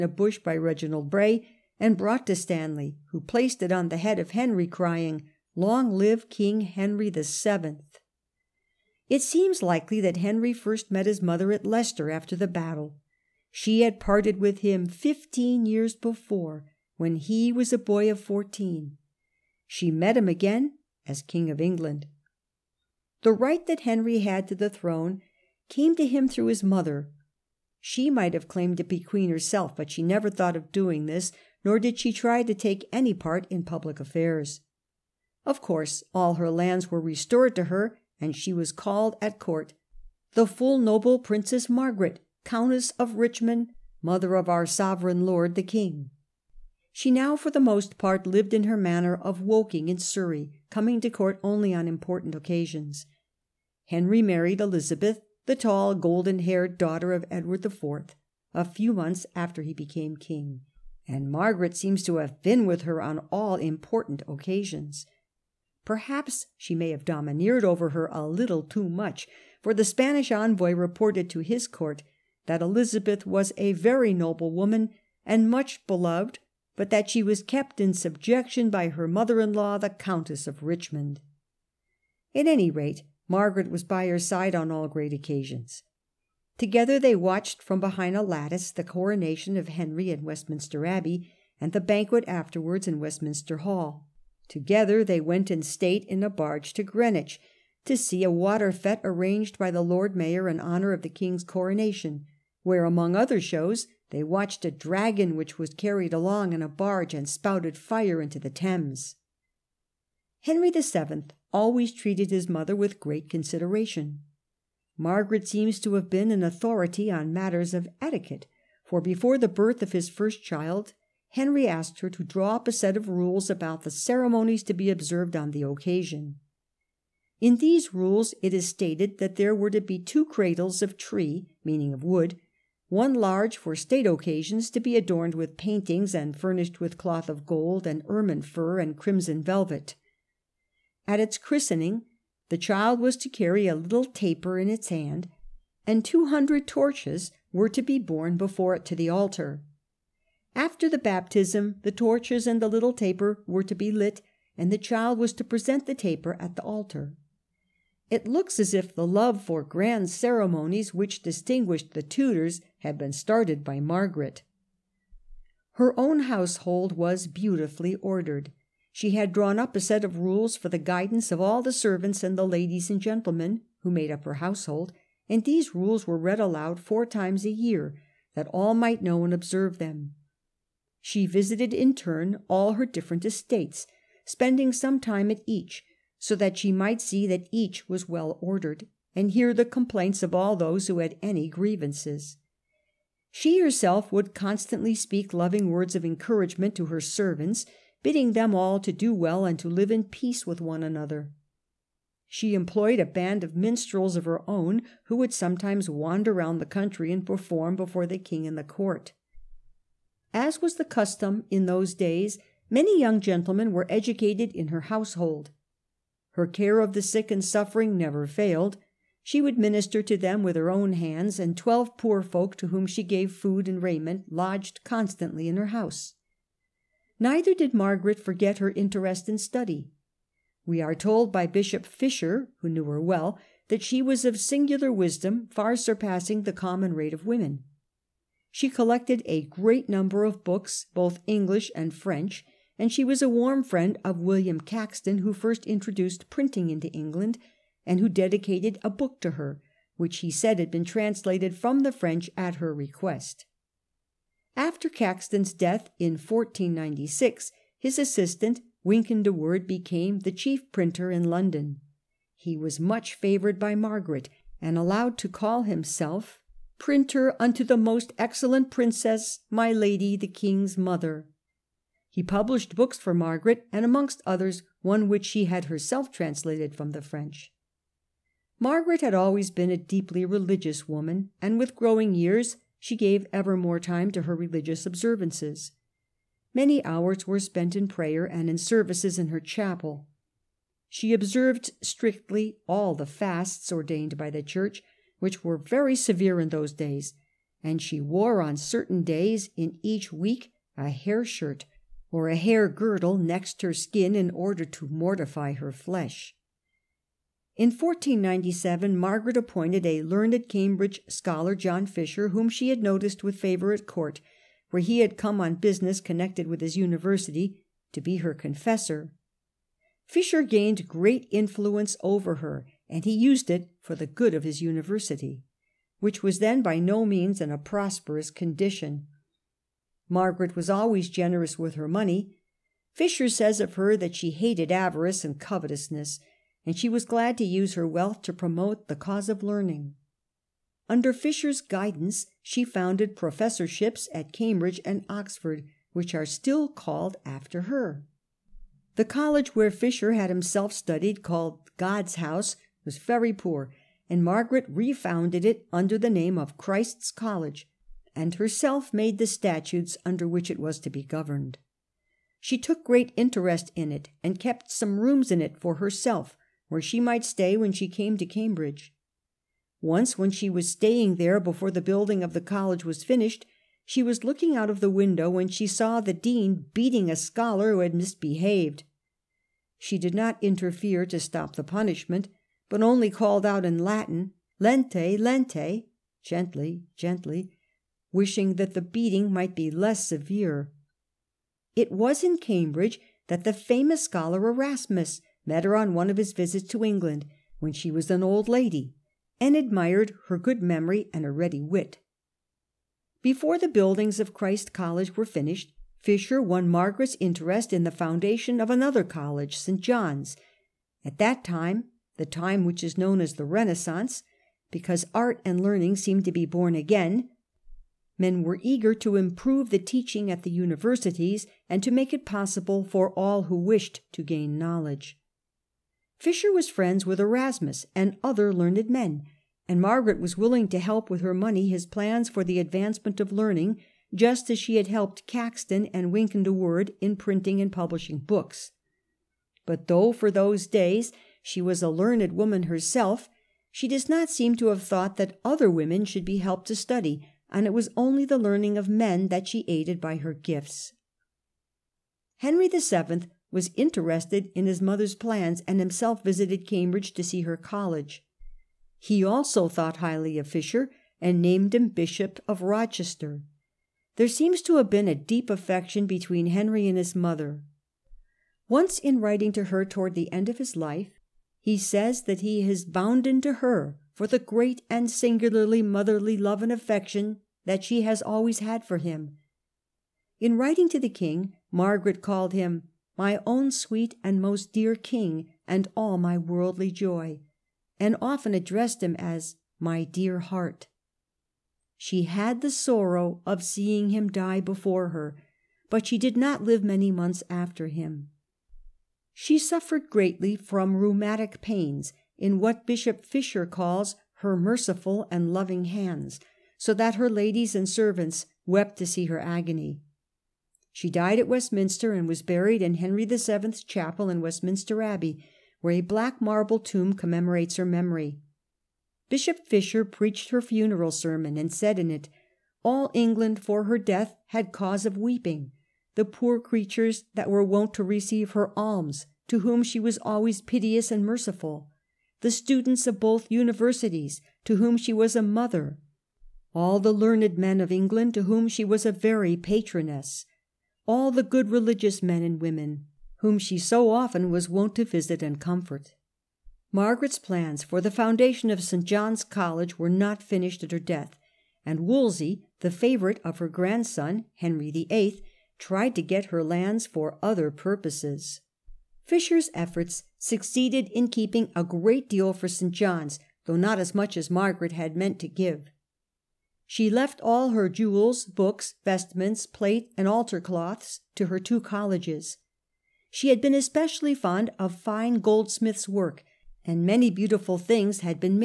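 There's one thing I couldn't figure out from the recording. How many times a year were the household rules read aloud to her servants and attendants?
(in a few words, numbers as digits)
4.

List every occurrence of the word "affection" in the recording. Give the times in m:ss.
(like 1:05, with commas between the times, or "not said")
7:45, 7:56.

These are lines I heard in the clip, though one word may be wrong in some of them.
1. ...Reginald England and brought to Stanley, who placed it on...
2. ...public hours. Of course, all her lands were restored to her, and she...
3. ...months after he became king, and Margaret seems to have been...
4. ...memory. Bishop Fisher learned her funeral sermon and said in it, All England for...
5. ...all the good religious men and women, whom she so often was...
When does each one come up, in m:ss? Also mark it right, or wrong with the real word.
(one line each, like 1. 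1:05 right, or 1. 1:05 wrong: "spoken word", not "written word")
1. 0:00 wrong: "Bray", not "England"
2. 0:33 wrong: "affairs", not "hours"
3. 0:58 right
4. 8:37 wrong: "preached", not "learned"
5. 9:01 right.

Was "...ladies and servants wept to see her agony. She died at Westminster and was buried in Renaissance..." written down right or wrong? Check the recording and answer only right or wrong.
wrong.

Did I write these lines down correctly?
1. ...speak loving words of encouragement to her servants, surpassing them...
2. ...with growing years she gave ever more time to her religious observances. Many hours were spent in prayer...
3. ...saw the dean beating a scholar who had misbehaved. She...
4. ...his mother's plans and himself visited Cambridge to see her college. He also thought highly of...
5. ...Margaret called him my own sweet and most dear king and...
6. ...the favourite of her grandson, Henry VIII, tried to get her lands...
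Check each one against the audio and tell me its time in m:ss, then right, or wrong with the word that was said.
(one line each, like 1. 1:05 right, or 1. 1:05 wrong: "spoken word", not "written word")
1. 3:14 wrong: "bidding", not "surpassing"
2. 4:41 right
3. 6:15 right
4. 7:34 right
5. 8:01 right
6. 9:12 right.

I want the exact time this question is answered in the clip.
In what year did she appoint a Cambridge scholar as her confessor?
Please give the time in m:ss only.
5:07.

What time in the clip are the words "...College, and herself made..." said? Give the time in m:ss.
5:57.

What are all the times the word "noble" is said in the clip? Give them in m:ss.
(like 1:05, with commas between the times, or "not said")
0:40, 1:14.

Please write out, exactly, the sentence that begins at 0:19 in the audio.
She met him again as King of England.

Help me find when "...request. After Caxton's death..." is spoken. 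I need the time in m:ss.
4:12.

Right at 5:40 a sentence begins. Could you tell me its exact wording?
Under Fisher's guidance, she founded professorships at Cambridge and Oxford, which are still called after her.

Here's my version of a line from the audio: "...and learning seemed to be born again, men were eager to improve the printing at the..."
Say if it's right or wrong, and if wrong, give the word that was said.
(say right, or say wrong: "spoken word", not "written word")
wrong: "teaching", not "printing".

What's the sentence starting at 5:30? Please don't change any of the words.
Margaret was always generous with her money.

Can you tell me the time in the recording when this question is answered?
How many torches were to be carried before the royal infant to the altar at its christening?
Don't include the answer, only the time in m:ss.
2:26.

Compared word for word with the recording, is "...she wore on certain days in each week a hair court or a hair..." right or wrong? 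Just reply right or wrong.
wrong.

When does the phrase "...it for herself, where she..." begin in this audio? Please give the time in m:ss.
6:05.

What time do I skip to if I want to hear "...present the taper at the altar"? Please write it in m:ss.
2:35.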